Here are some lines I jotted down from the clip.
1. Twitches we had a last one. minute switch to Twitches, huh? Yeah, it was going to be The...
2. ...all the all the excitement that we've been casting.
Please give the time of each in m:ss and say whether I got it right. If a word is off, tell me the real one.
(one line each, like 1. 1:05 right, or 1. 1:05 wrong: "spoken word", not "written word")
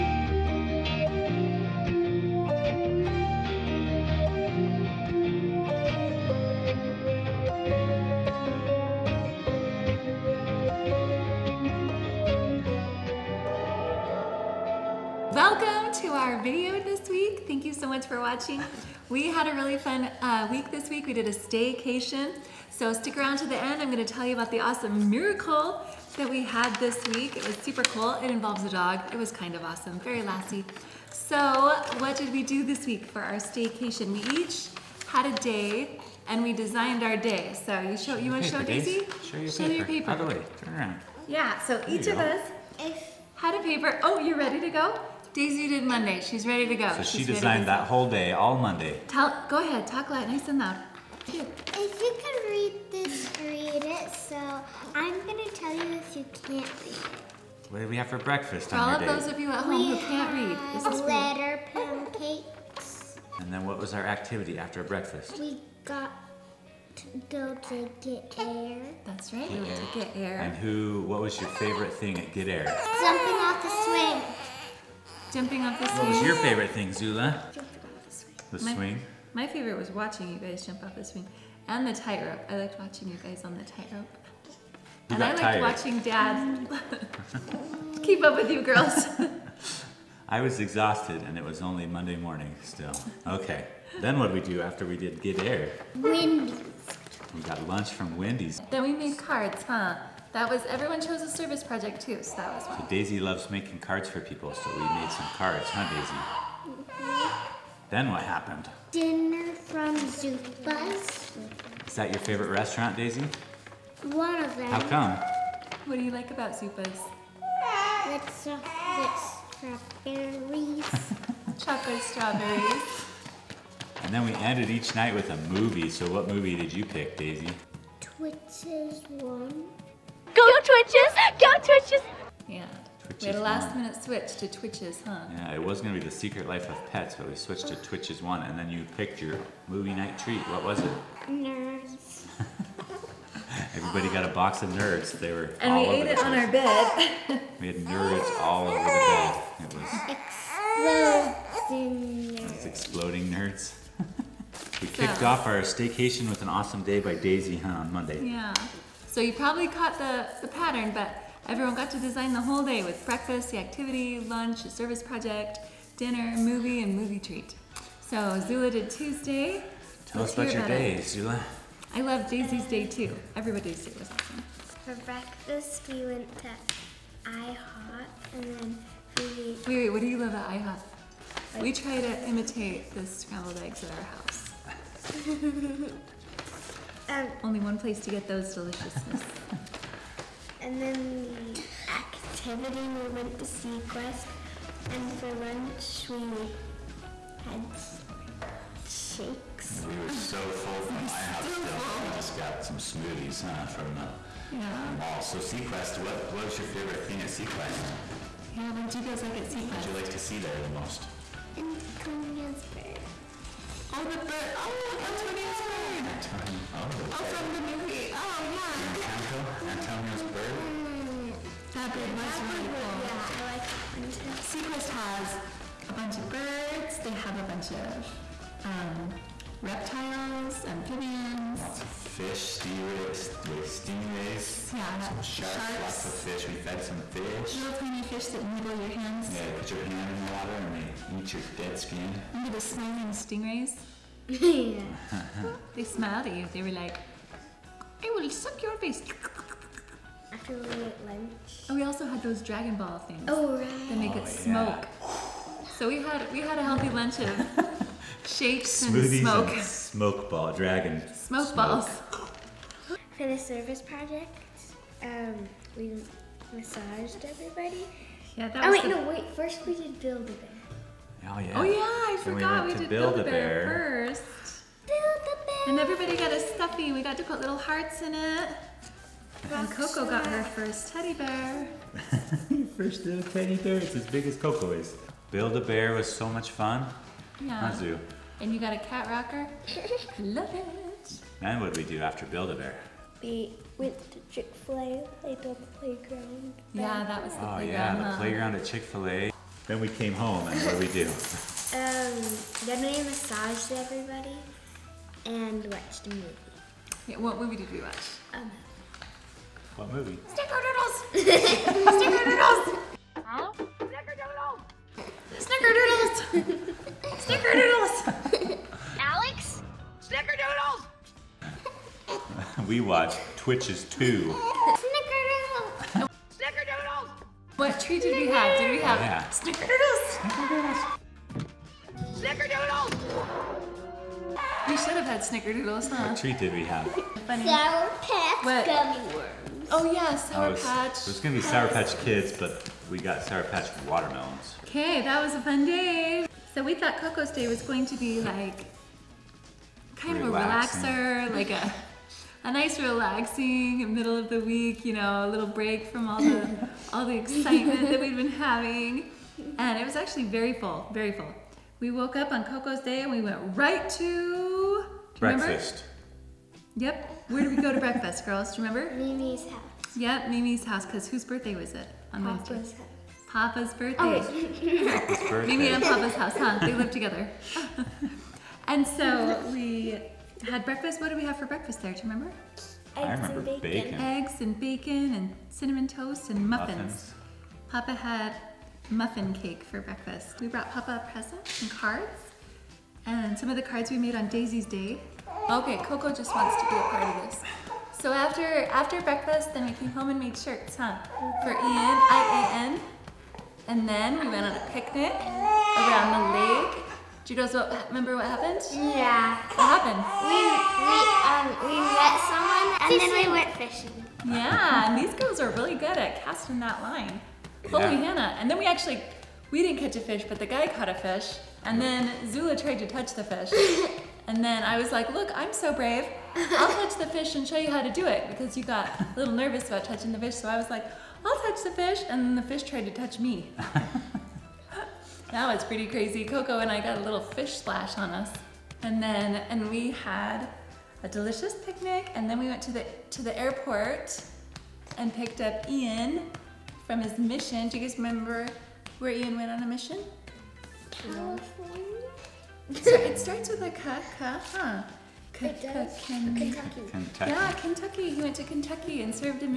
1. 2:13 right
2. 5:56 wrong: "having", not "casting".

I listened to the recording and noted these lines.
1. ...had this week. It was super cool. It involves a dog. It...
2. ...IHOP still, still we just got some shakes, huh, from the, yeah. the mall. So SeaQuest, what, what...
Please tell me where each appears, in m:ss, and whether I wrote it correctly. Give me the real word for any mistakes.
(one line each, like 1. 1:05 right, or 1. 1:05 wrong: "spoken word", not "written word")
1. 0:26 right
2. 3:21 wrong: "smoothies", not "shakes".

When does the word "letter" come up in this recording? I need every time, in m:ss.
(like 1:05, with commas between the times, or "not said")
1:01.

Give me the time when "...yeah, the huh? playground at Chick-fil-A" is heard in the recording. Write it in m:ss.
4:57.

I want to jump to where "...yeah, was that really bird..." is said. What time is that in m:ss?
3:42.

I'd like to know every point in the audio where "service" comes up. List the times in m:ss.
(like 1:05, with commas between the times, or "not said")
1:41, 2:44, 4:23.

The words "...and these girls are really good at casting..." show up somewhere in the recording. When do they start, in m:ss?
6:54.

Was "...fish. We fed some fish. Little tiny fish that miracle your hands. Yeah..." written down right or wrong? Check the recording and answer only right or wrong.
wrong.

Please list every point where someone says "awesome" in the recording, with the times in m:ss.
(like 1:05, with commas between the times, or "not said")
0:24, 0:29, 2:36, 2:54.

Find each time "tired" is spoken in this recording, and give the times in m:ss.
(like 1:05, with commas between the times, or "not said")
1:25.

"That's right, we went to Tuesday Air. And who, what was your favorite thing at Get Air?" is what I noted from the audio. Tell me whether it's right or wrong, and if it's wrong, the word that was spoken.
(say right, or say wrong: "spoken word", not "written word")
wrong: "Get", not "Tuesday".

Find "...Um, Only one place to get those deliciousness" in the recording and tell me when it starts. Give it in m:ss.
3:07.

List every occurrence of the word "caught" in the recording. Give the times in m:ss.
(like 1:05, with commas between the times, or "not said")
2:39, 7:00.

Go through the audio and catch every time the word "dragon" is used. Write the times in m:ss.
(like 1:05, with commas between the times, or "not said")
4:12, 4:20.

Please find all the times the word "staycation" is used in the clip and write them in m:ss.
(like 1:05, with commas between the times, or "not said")
0:21, 0:33, 2:35.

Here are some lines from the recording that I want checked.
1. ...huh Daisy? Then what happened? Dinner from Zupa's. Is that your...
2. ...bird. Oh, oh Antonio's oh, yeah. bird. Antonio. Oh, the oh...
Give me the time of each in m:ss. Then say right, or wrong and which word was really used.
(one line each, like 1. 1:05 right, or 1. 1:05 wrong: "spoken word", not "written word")
1. 1:45 right
2. 3:34 right.